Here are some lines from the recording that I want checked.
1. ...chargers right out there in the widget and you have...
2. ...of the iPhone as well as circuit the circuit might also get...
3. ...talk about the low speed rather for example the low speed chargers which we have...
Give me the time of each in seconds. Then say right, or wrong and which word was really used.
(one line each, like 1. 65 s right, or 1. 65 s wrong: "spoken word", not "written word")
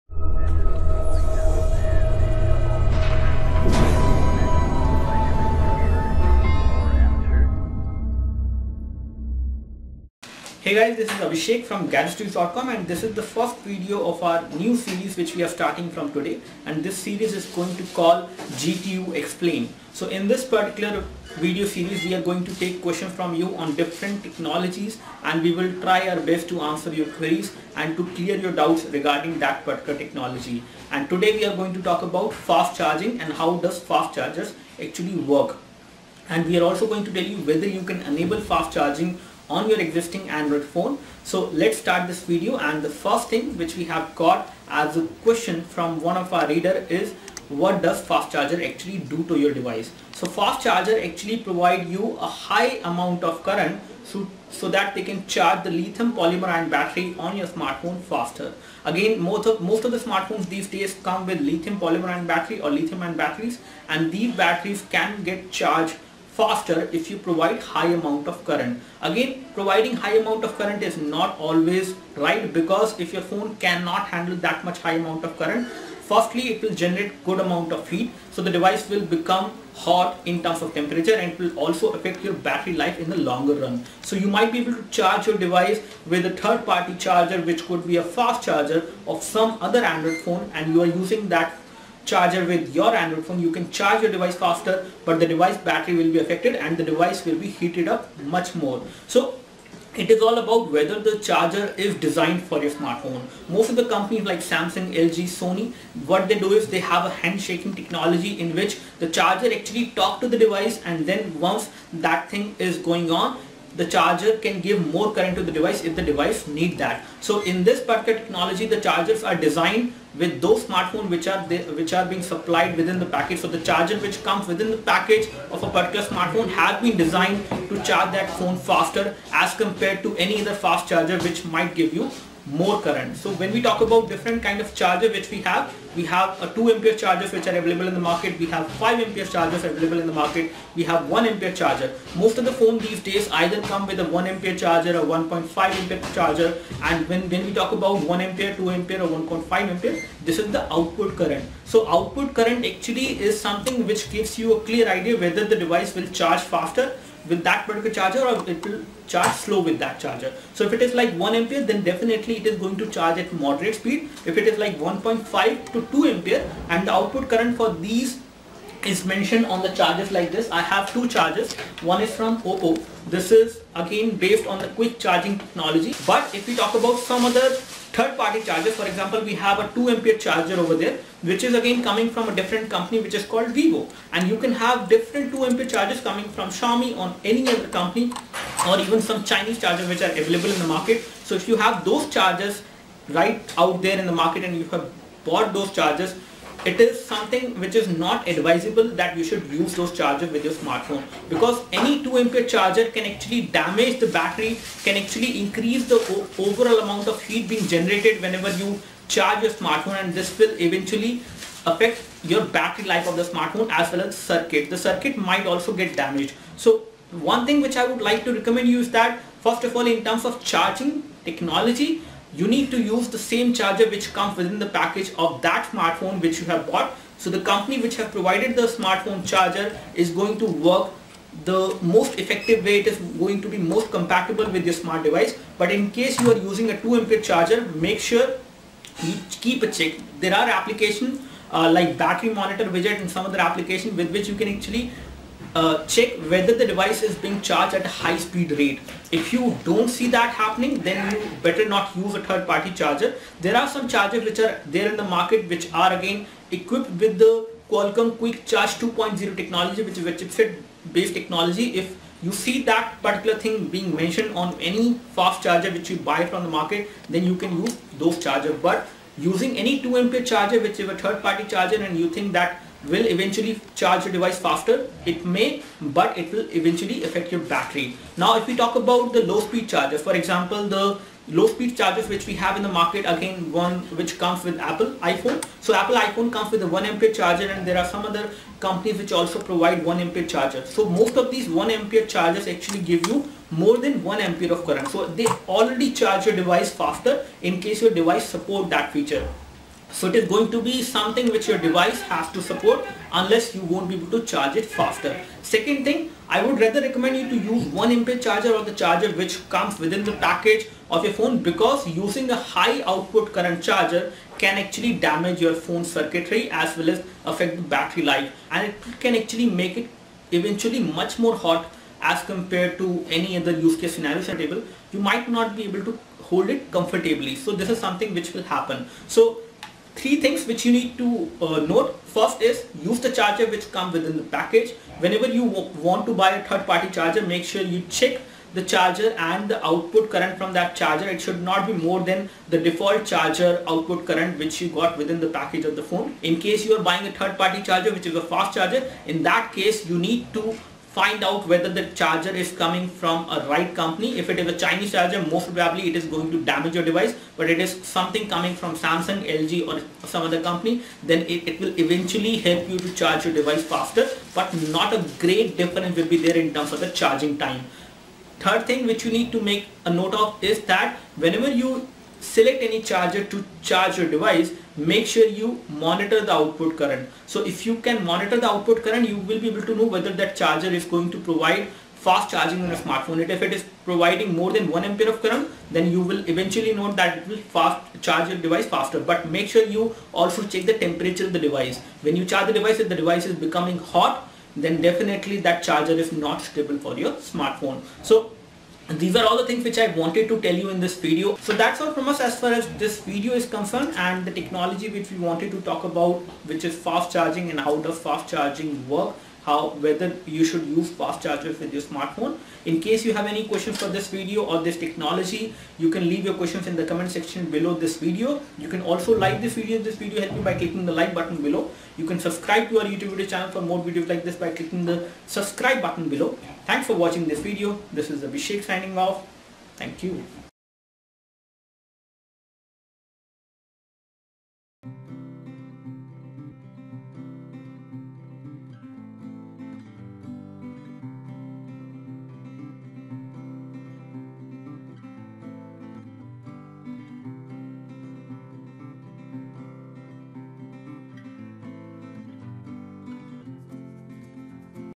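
1. 192 s wrong: "market", not "widget"
2. 213 s wrong: "smartphone", not "iPhone"
3. 278 s wrong: "charger", not "rather".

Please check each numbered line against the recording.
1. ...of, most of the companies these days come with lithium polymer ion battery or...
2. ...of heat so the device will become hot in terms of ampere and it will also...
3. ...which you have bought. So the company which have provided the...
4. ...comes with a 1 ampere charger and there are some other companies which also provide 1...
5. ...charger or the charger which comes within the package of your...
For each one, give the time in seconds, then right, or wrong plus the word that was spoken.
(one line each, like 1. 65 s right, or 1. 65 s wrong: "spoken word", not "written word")
1. 59 s wrong: "smartphones", not "companies"
2. 77 s wrong: "temperature", not "ampere"
3. 226 s right
4. 286 s right
5. 308 s right.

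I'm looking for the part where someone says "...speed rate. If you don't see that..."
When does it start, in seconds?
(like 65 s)
248 s.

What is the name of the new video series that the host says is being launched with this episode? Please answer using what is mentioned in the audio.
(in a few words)
GTU Explain.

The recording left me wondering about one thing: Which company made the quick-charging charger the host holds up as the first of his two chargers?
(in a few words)
OPPO.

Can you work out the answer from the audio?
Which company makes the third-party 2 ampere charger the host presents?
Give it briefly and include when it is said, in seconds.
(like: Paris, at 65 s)
Vivo, at 183 s.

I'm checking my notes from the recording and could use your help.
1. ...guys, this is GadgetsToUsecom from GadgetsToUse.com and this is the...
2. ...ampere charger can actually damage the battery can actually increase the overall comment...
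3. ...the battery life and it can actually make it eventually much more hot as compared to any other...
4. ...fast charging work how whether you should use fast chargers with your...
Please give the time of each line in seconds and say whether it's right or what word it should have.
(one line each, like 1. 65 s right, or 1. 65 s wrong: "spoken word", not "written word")
1. 10 s wrong: "Abhishek", not "GadgetsToUsecom"
2. 202 s wrong: "amount", not "comment"
3. 317 s right
4. 407 s right.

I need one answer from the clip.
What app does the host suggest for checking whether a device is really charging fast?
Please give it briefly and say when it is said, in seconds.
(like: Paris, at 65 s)
battery monitor widget, at 241 s.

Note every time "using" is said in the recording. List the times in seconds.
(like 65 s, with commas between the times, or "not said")
91 s, 236 s, 269 s, 311 s.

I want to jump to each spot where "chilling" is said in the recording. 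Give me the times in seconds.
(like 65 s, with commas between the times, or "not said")
not said.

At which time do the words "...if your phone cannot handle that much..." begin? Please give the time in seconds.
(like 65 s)
72 s.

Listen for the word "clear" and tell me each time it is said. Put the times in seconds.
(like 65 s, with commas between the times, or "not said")
28 s, 154 s.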